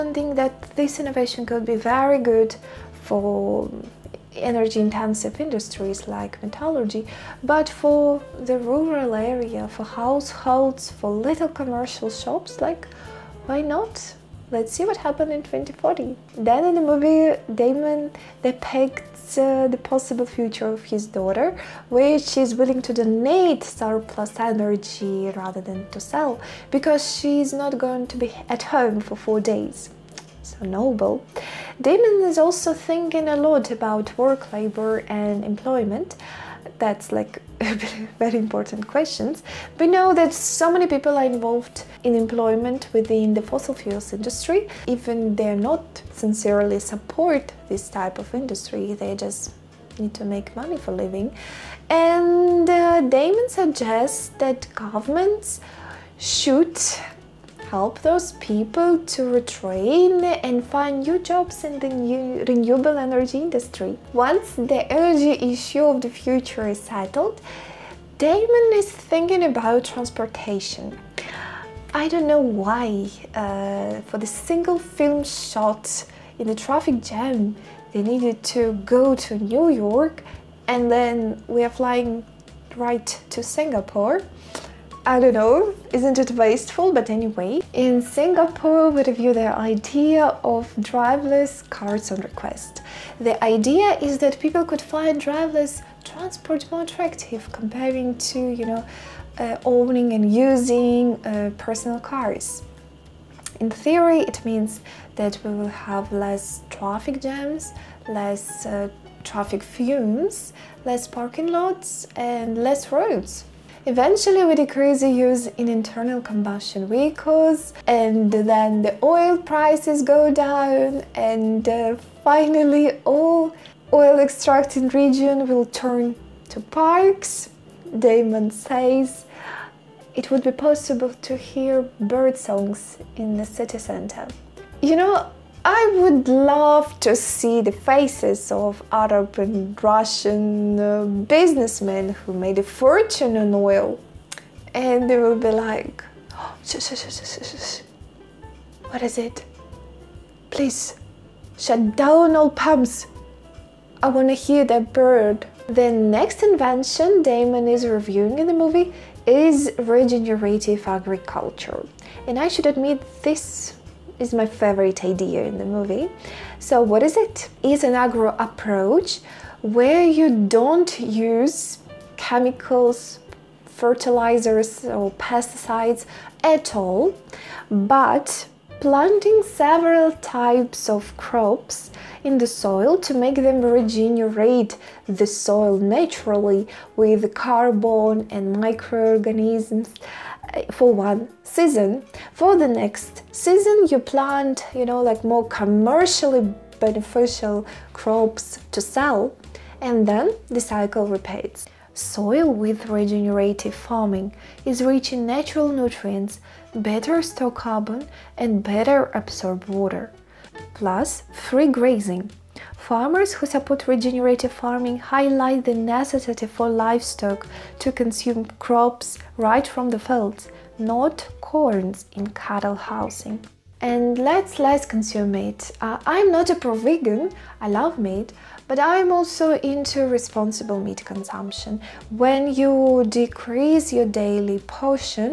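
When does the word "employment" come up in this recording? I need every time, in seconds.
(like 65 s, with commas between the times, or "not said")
35 s, 42 s.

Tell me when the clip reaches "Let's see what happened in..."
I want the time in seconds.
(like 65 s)
14 s.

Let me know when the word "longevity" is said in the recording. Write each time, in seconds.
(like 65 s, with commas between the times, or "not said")
not said.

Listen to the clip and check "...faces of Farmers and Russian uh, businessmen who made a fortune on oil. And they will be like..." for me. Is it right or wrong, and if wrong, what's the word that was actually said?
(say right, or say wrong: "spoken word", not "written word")
wrong: "Arab", not "Farmers".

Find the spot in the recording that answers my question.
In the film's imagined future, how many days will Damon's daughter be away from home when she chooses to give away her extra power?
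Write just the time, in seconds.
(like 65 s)
29 s.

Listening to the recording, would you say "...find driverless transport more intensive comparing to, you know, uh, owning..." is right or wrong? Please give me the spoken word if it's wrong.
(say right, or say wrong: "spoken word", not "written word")
wrong: "attractive", not "intensive".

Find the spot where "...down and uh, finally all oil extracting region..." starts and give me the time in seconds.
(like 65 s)
120 s.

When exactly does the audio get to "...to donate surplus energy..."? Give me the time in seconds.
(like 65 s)
22 s.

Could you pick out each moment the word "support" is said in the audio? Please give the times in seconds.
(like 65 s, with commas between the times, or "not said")
46 s, 213 s.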